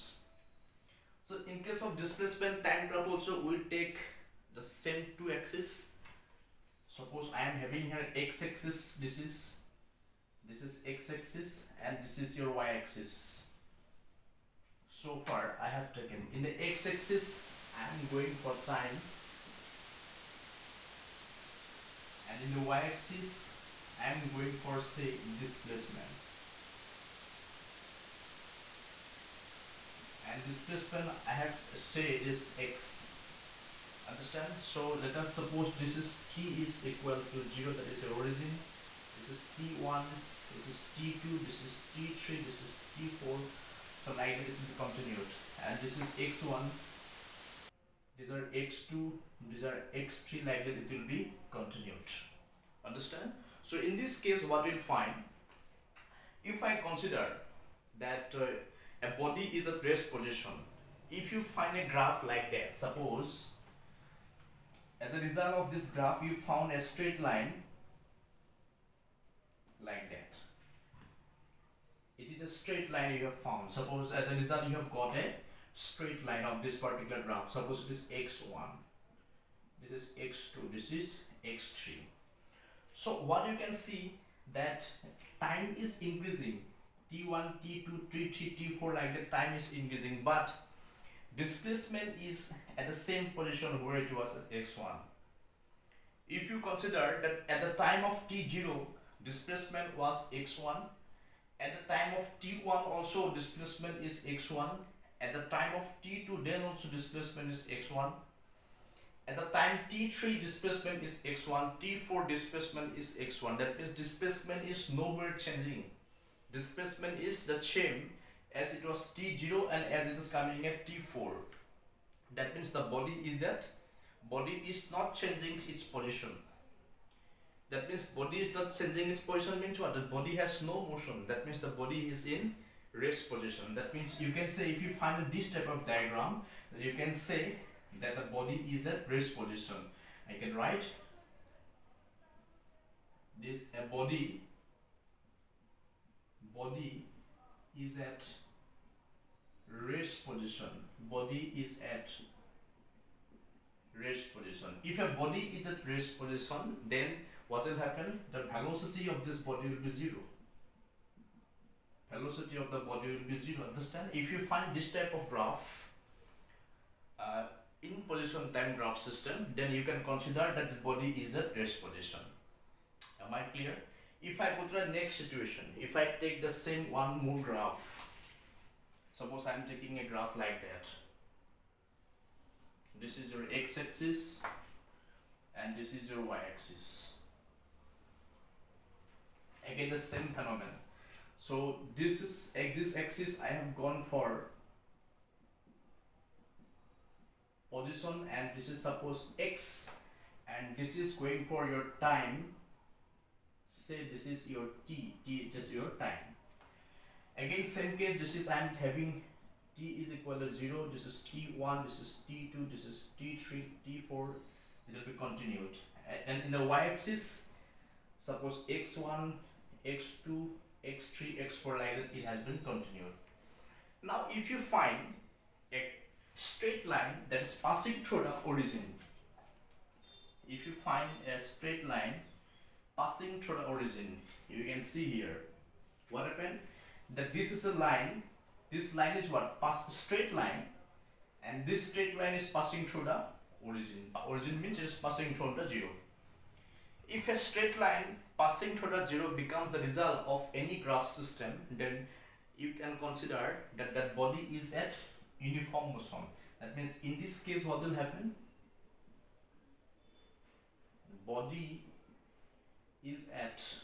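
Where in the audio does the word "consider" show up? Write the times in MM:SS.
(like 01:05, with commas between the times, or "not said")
00:56, 01:36, 02:50, 04:12.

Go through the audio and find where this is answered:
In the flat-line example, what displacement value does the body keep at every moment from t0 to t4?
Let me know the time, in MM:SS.
01:51.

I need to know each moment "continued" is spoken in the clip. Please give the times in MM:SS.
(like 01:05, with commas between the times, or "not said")
00:44, 00:51, 03:35, 03:42.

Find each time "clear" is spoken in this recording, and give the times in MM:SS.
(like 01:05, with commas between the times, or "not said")
02:53.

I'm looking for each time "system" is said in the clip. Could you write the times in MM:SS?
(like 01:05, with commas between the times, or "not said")
02:48, 04:11.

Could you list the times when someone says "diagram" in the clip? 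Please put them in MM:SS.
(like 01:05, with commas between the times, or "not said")
02:15.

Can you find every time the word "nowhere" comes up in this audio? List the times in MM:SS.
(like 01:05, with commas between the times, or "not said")
01:54.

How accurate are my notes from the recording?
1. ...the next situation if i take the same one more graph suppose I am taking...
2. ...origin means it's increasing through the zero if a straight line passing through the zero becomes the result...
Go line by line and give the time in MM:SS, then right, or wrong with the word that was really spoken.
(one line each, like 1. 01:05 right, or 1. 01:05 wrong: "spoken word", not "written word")
1. 02:54 right
2. 04:04 wrong: "passing", not "increasing".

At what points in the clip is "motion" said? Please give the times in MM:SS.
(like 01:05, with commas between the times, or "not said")
02:10, 04:15.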